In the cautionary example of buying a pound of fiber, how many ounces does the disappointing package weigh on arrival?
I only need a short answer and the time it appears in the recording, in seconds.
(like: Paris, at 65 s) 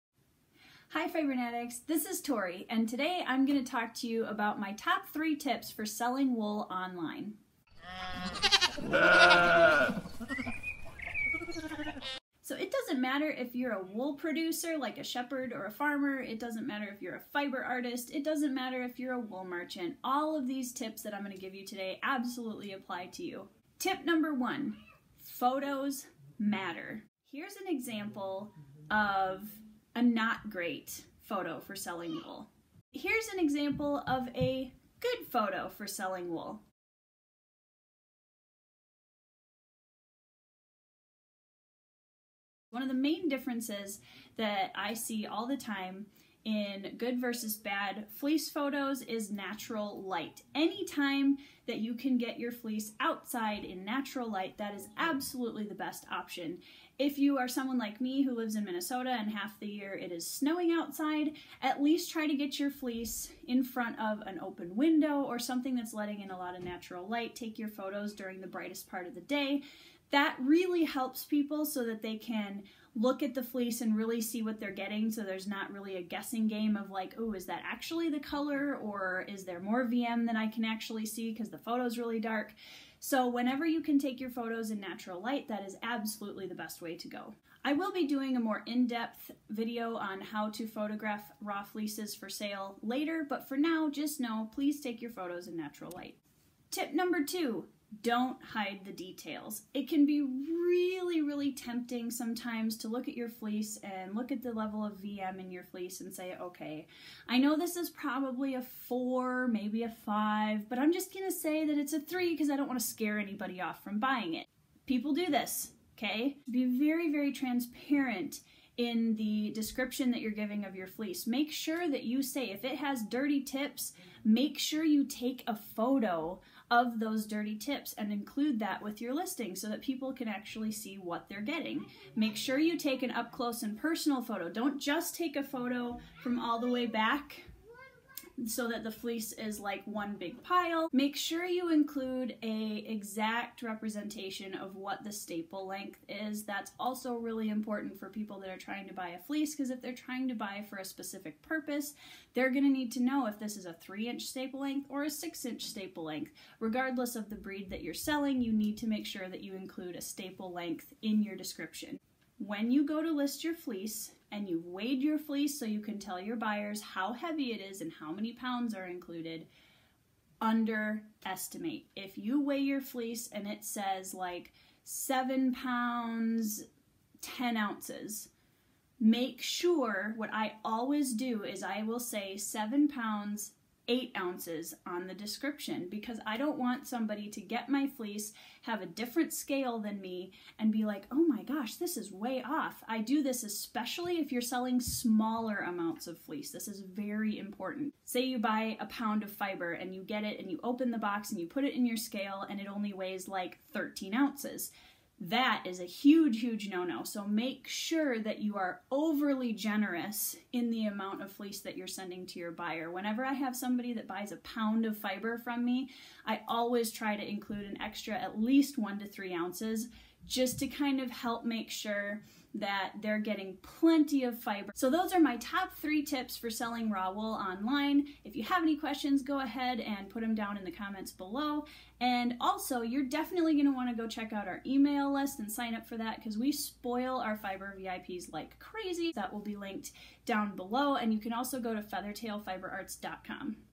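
13 ounces, at 203 s.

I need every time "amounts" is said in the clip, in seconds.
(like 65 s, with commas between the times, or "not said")
195 s, 210 s.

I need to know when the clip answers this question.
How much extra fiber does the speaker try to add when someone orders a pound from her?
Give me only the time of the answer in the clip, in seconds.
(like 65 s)
218 s.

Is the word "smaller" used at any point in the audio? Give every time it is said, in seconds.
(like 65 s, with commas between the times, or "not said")
194 s.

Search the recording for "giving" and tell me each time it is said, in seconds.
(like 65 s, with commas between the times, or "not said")
120 s.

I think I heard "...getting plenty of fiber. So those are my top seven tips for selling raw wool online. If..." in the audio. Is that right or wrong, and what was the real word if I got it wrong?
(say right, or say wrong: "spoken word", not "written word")
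wrong: "three", not "seven".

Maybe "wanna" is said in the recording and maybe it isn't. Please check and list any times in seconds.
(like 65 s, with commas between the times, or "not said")
112 s, 233 s.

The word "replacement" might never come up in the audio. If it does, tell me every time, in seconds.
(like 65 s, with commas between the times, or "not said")
not said.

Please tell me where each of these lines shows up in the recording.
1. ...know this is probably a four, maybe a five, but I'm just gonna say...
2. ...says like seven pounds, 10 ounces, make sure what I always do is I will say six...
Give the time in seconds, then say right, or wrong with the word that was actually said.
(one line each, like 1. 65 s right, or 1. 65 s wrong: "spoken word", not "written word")
1. 107 s right
2. 173 s wrong: "seven", not "six".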